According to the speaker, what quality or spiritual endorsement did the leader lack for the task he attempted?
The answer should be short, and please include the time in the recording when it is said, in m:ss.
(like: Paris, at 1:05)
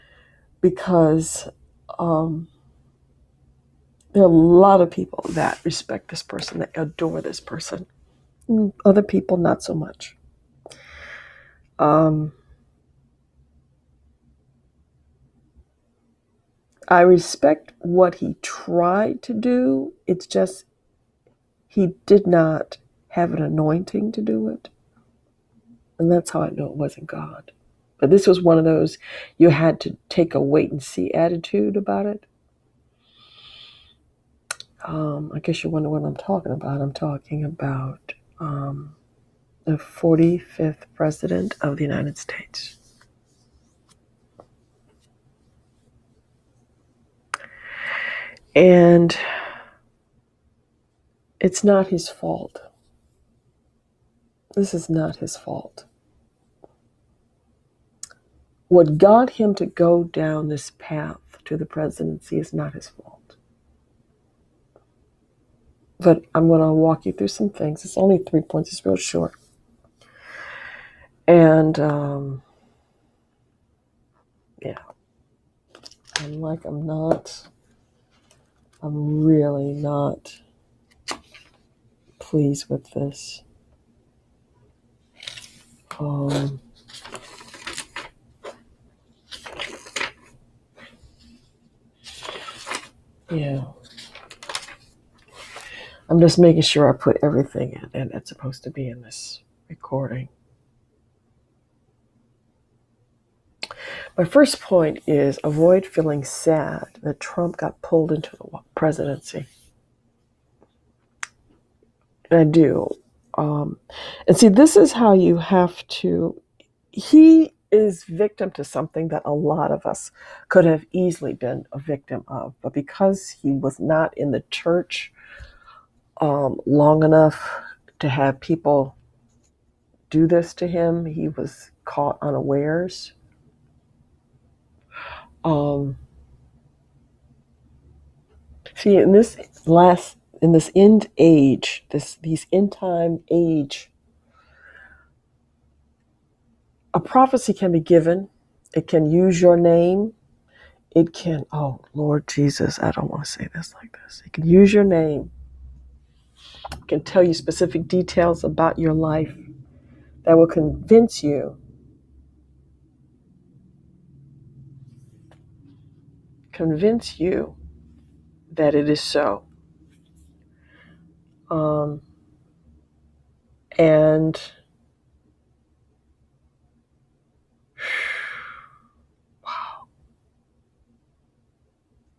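An anointing, at 0:23.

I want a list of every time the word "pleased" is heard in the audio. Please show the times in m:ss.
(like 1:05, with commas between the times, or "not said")
1:22.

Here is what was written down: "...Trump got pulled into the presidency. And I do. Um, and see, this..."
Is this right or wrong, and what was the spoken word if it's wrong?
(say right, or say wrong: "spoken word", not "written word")
right.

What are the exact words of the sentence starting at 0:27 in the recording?
But this was one of those you had to take a wait and see attitude about it.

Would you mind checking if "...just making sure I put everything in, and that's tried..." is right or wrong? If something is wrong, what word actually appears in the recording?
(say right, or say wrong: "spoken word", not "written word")
wrong: "supposed", not "tried".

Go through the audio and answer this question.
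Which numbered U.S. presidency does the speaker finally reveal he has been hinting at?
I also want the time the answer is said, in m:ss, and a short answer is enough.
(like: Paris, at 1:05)
45th, at 0:39.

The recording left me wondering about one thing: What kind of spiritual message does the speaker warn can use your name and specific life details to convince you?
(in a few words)
A prophecy.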